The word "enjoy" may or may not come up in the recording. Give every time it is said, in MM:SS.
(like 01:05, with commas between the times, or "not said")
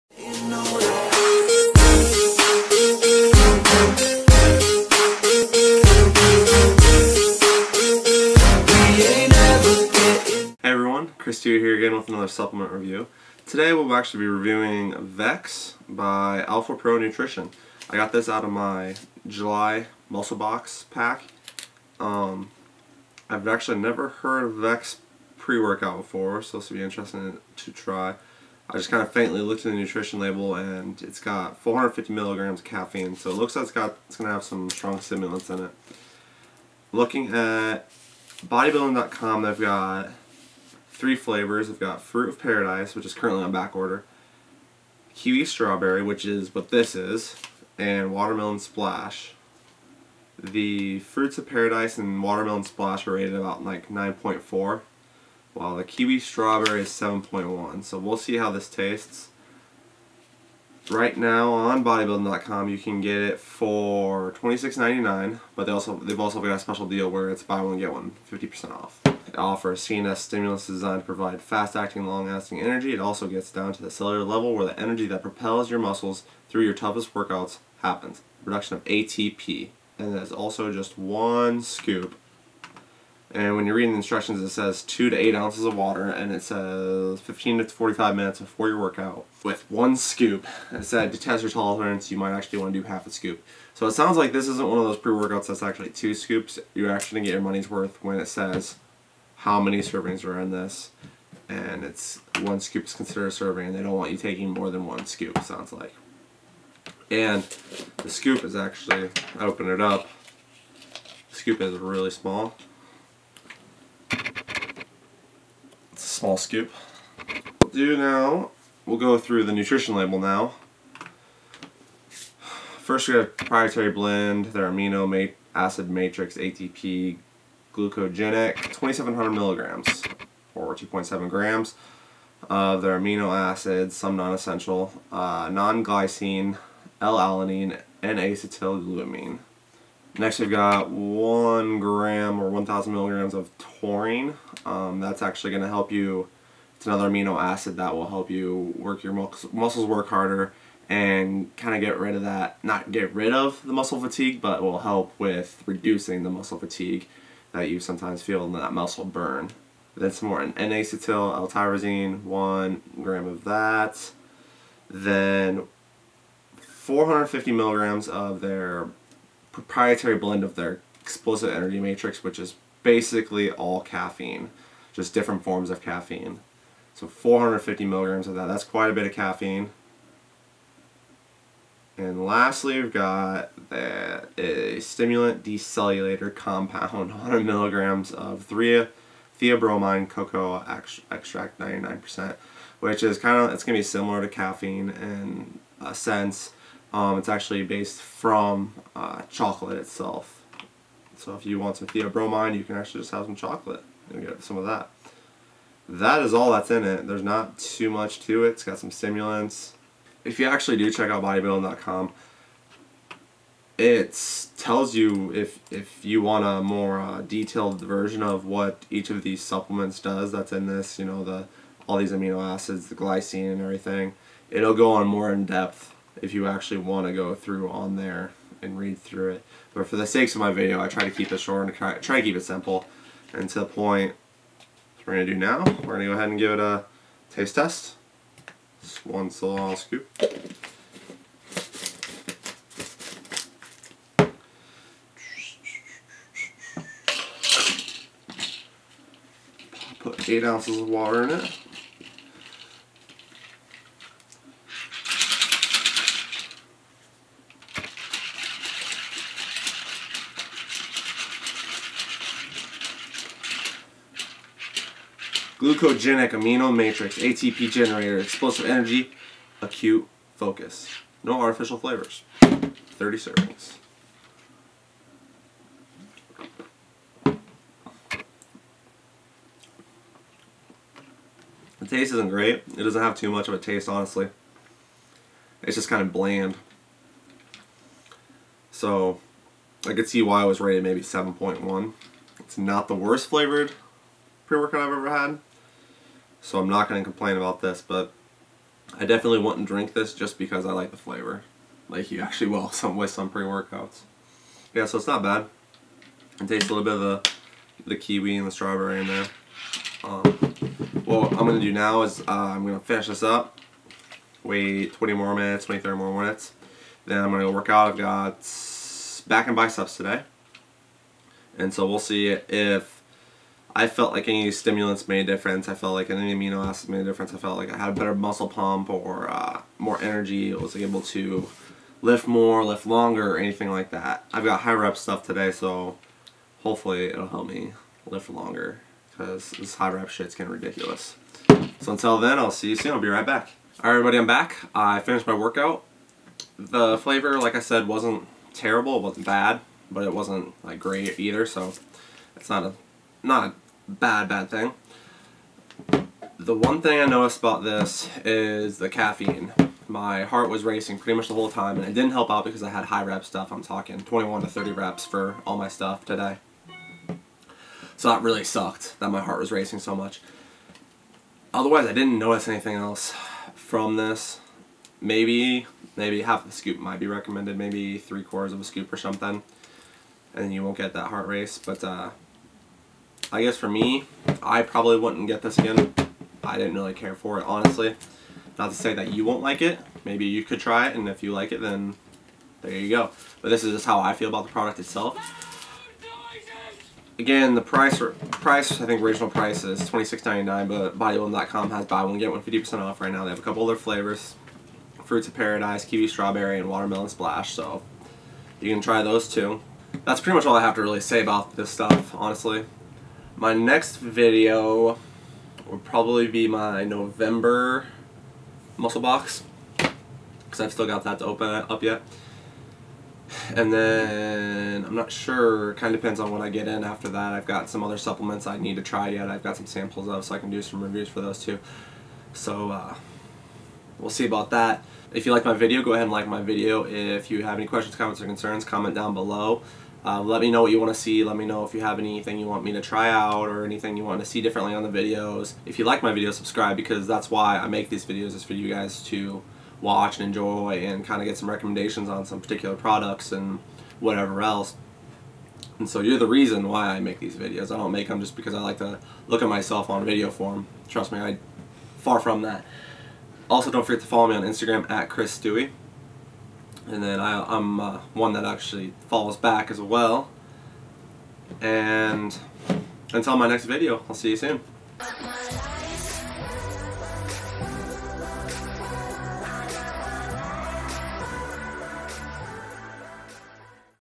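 07:30.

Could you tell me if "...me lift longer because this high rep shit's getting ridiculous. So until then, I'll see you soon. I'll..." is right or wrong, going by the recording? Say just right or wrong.
right.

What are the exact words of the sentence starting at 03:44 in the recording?
It'll go on more in depth if you actually want to go through on there and read through it.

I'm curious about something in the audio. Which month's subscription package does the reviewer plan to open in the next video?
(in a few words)
November.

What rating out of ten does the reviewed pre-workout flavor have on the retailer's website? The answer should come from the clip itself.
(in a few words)
7.1.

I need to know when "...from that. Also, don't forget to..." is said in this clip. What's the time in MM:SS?
07:42.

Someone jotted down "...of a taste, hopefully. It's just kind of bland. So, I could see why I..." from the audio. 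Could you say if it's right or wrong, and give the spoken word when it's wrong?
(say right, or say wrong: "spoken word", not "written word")
wrong: "honestly", not "hopefully".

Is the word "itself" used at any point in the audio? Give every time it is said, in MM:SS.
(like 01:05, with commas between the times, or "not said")
03:19, 06:34.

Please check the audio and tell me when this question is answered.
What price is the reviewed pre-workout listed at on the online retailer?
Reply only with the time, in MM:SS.
01:04.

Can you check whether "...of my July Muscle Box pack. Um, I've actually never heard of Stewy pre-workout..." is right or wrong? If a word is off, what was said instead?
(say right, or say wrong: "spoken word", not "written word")
wrong: "Vex", not "Stewy".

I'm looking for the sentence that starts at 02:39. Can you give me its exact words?
Then some more N-acetyl L-tyrosine, one gram of that.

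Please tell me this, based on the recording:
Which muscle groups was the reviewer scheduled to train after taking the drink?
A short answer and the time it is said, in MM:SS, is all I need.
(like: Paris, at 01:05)
Back and biceps, at 05:19.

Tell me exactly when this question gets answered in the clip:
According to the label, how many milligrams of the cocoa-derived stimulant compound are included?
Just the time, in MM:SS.
03:07.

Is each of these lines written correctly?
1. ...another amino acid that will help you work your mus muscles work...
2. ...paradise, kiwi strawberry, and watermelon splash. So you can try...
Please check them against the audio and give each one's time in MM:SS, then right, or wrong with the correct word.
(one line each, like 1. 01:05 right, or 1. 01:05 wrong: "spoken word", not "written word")
1. 02:26 right
2. 06:45 right.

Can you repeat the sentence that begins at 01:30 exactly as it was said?
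It said to test your tolerance, you might actually want to do half a scoop.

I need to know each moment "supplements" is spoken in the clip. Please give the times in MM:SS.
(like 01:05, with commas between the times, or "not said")
00:12, 03:39, 07:07.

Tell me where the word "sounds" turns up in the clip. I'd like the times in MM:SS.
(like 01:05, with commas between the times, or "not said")
01:33, 01:45.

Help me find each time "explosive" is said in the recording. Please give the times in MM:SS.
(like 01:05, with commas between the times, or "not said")
02:51, 04:28.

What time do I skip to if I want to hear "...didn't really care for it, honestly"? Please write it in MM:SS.
06:26.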